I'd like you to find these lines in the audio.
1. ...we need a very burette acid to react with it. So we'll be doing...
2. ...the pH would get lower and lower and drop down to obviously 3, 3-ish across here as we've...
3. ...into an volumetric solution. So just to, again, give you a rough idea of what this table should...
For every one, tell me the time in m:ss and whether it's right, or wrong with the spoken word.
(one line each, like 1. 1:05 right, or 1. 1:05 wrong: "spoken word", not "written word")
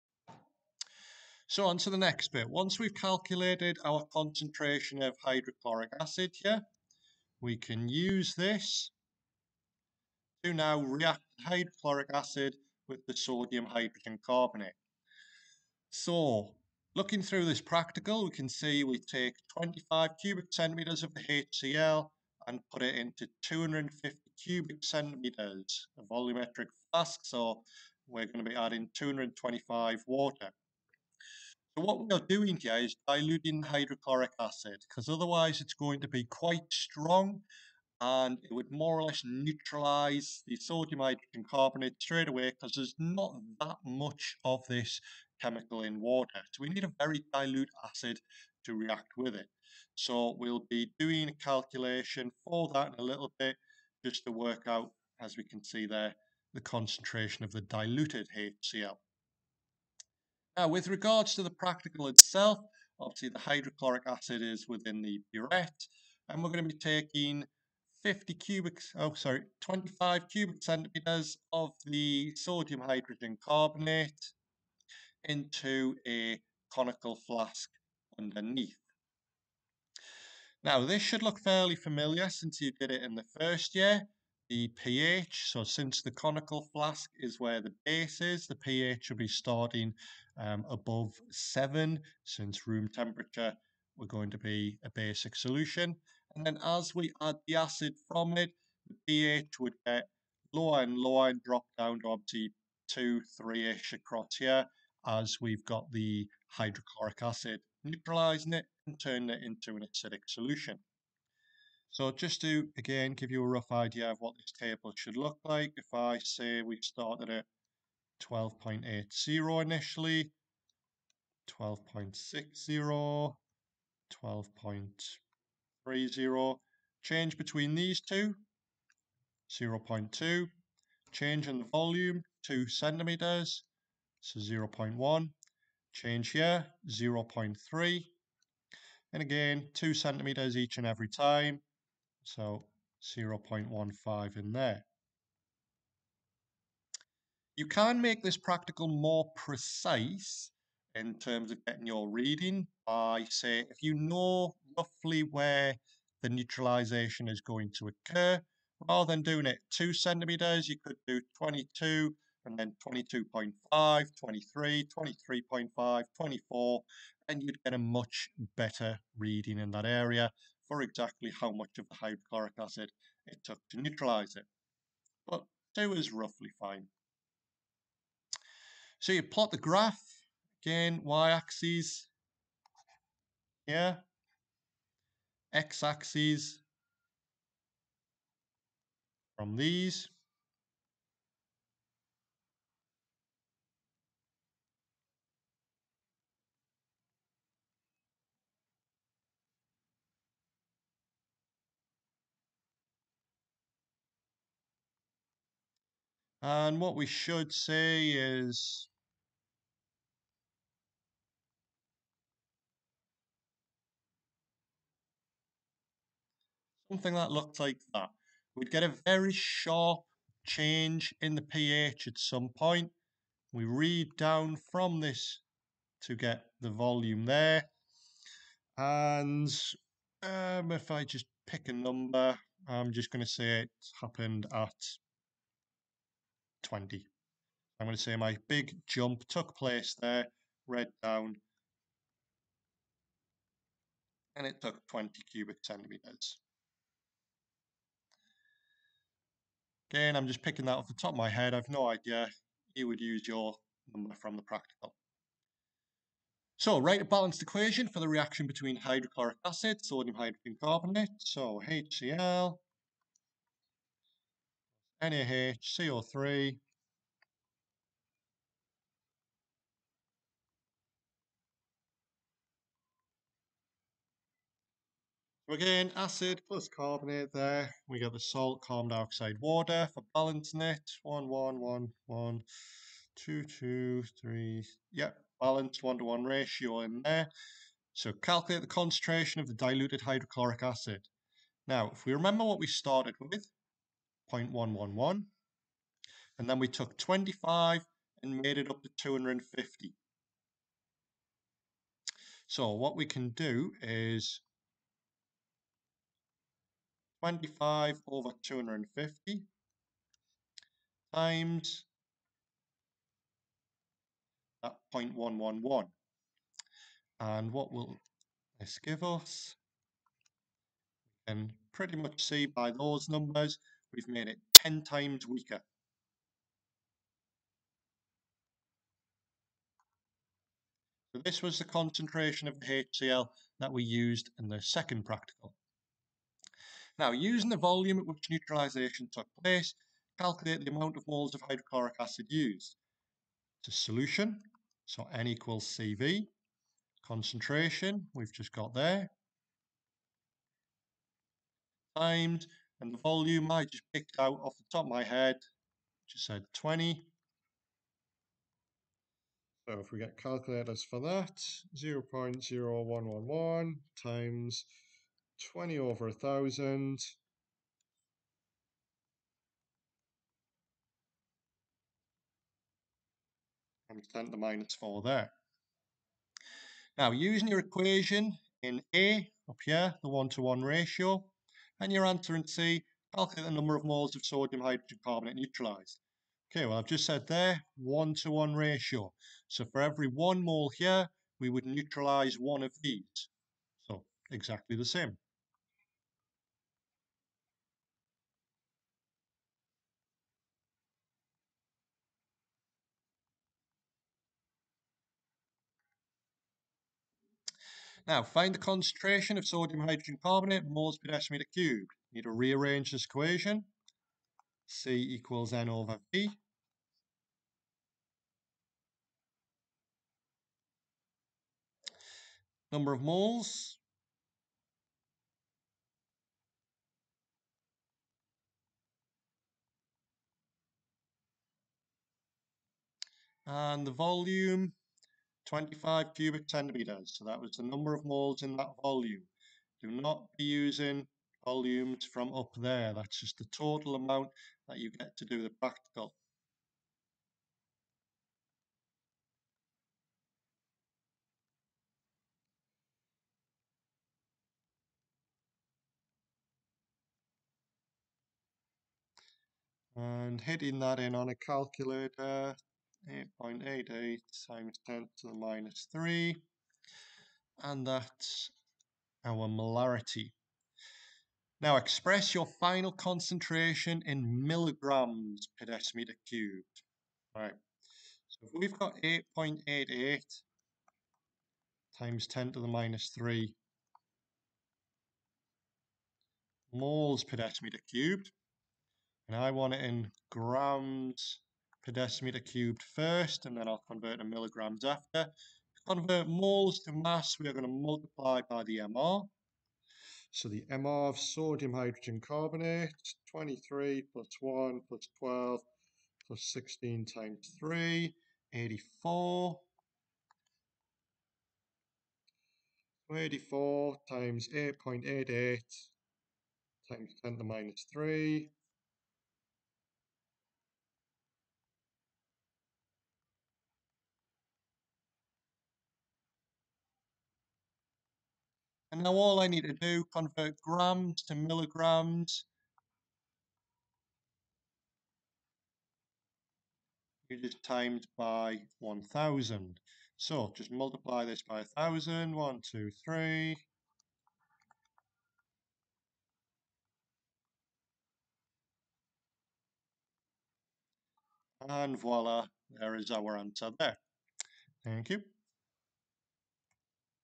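1. 0:46 wrong: "dilute", not "burette"
2. 1:38 wrong: "2", not "3"
3. 1:49 wrong: "acidic", not "volumetric".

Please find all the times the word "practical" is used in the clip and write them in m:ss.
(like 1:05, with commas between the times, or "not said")
0:17, 1:01, 2:28, 4:14, 5:35, 7:25.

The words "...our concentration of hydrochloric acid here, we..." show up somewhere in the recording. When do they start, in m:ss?
0:03.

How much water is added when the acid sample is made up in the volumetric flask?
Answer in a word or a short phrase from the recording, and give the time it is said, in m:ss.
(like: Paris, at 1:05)
225 cm3, at 0:28.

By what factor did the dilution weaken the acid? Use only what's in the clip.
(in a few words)
10 times.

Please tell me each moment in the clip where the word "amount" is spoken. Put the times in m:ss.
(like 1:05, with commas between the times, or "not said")
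5:40, 7:23.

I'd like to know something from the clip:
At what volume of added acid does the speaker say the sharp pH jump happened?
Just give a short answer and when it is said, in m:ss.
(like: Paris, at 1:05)
20 cm3, at 4:04.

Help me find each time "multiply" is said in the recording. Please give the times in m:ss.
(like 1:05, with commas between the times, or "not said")
8:17, 9:00.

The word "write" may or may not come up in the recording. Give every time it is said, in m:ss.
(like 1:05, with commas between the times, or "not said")
4:16.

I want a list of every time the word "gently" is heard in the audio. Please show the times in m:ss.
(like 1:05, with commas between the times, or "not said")
not said.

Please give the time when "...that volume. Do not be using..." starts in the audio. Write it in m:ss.
7:18.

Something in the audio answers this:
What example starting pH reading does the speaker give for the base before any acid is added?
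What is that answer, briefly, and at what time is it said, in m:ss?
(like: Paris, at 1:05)
12.80, at 1:58.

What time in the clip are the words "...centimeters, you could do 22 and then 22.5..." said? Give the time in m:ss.
2:39.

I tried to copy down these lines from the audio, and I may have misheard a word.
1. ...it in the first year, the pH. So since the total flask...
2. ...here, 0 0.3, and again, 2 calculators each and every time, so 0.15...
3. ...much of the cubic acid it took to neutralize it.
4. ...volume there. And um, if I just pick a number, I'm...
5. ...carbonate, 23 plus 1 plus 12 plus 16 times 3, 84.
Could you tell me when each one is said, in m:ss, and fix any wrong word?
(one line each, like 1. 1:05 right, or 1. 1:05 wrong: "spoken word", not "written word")
1. 1:22 wrong: "conical", not "total"
2. 2:16 wrong: "centimeters", not "calculators"
3. 2:51 wrong: "hydrochloric", not "cubic"
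4. 3:46 right
5. 8:22 right.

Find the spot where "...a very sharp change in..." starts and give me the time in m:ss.
3:38.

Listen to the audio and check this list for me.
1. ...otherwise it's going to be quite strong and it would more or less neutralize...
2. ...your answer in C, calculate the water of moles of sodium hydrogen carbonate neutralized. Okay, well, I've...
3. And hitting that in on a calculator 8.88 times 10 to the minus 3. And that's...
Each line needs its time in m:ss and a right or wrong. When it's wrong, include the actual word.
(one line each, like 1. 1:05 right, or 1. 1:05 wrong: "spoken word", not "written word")
1. 0:35 right
2. 6:21 wrong: "number", not "water"
3. 7:39 right.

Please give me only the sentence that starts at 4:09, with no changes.
Again, I'm just picking that off the top of my head.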